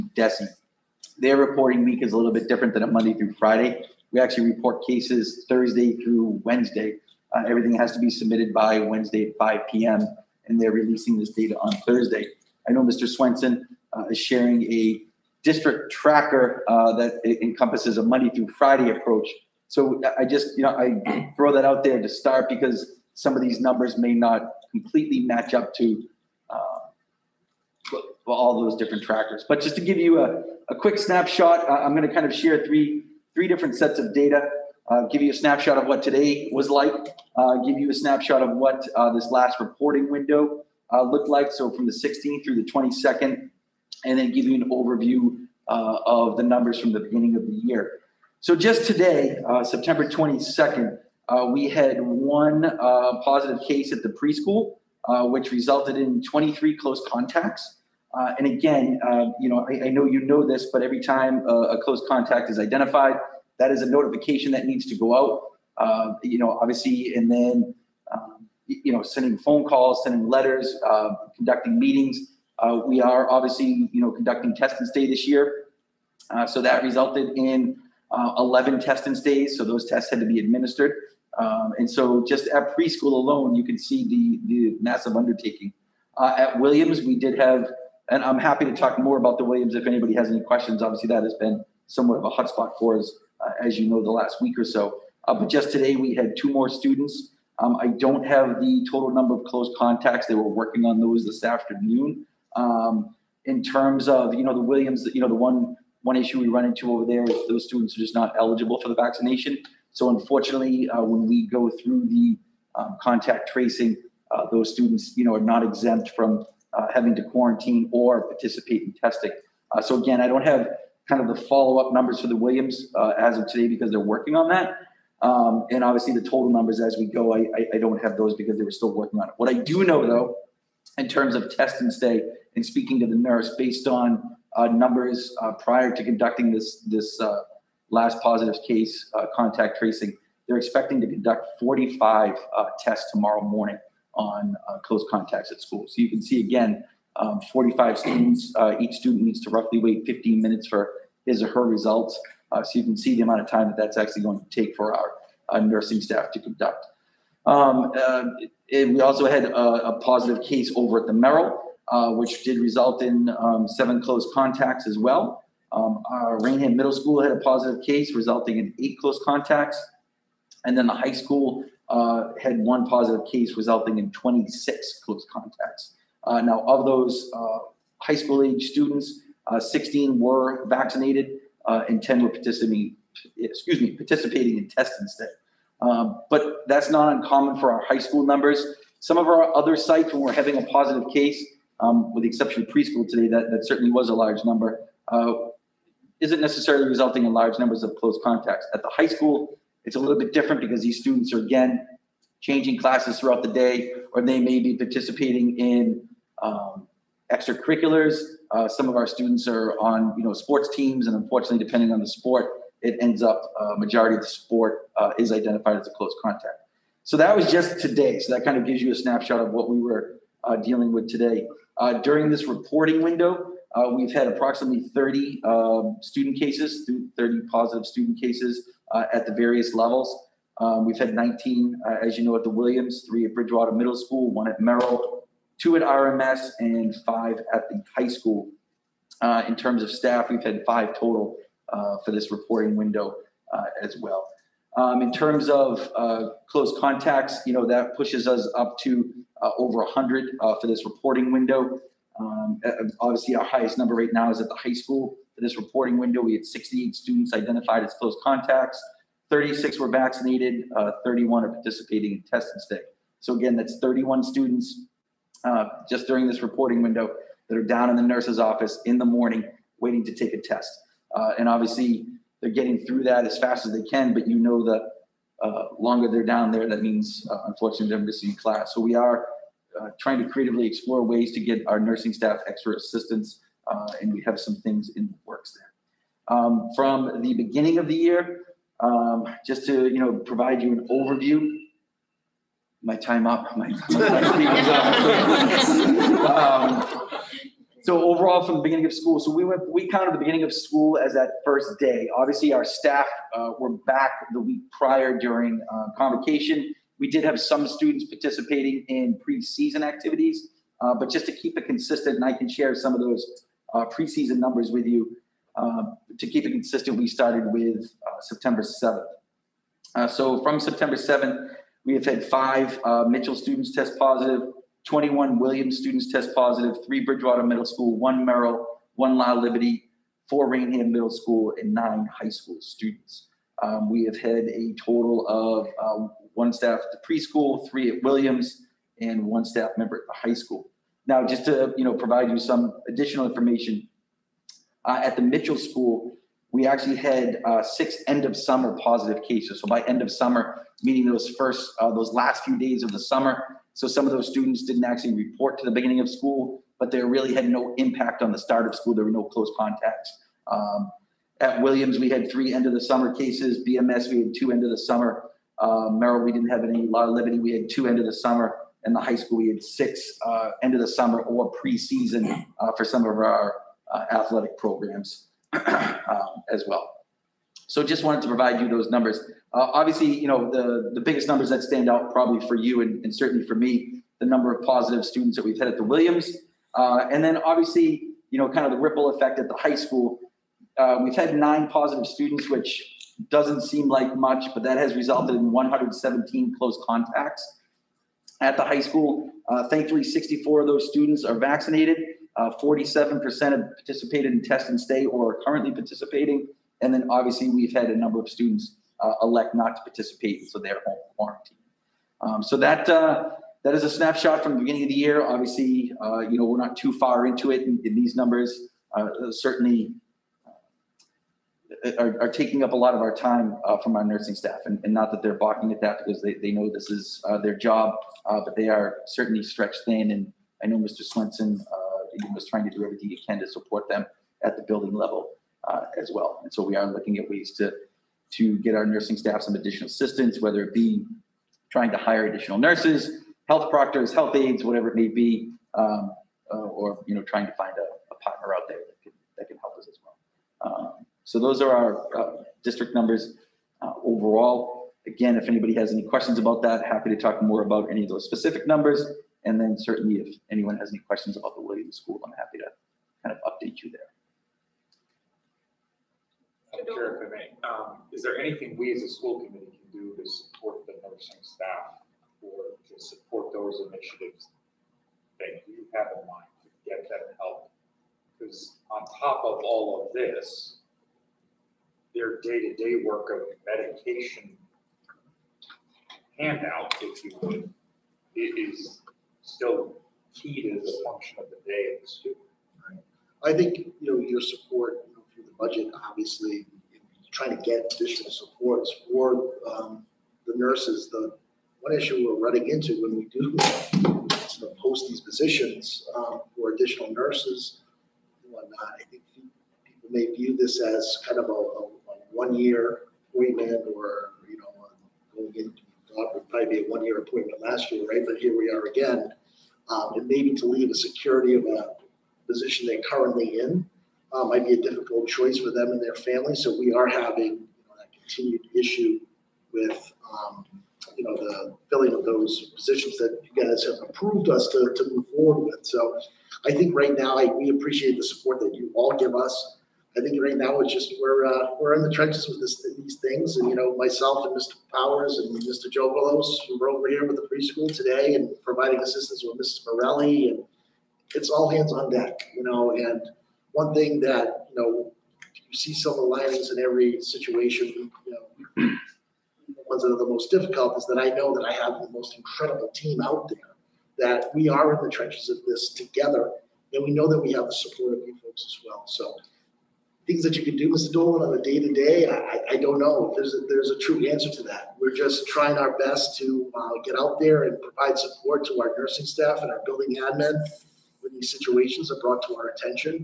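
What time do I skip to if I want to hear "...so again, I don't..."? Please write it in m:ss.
1:59.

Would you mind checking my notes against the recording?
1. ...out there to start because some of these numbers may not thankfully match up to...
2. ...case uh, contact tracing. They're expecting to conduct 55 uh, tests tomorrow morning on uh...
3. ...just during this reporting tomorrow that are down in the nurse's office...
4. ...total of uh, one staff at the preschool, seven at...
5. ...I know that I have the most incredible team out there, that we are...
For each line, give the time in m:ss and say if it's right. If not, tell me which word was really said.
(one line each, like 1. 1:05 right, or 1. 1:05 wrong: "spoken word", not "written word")
1. 0:21 wrong: "completely", not "thankfully"
2. 2:18 wrong: "45", not "55"
3. 4:25 wrong: "window", not "tomorrow"
4. 5:34 wrong: "three", not "seven"
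5. 9:21 right.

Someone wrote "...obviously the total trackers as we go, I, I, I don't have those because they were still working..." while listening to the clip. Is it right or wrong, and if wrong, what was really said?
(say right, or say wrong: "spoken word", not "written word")
wrong: "numbers", not "trackers".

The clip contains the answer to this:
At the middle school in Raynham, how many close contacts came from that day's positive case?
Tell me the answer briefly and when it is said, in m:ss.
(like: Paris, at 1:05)
8, at 2:48.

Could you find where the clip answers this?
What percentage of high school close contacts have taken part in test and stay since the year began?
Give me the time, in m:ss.
6:42.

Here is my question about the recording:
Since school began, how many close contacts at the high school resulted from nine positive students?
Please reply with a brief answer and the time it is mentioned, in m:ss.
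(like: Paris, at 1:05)
117, at 6:35.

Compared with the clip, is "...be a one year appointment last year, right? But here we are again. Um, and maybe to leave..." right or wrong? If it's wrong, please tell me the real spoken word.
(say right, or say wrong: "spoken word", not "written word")
right.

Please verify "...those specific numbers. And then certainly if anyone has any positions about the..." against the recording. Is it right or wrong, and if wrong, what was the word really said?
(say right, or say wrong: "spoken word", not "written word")
wrong: "questions", not "positions".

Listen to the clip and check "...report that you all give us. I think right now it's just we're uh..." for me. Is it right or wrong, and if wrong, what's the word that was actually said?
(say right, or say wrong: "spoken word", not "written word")
wrong: "support", not "report".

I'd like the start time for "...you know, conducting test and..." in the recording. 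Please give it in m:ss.
1:13.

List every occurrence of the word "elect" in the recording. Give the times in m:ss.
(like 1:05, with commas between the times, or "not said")
6:49.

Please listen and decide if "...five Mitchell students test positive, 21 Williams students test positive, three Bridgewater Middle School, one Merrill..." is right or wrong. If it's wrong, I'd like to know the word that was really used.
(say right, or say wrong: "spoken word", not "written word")
right.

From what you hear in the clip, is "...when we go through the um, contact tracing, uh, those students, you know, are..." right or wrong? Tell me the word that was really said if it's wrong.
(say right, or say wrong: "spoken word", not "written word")
right.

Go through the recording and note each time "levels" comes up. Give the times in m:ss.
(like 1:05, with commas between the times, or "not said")
3:49, 7:14.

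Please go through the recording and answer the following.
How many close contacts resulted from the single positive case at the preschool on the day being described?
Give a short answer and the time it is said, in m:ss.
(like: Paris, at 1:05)
23, at 0:56.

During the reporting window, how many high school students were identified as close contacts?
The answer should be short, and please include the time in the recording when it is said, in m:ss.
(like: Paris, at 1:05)
68, at 4:16.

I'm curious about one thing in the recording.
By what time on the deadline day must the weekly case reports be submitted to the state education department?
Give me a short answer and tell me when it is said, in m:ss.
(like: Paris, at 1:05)
5 p.m., at 0:09.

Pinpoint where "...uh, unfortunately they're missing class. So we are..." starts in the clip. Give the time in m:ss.
4:37.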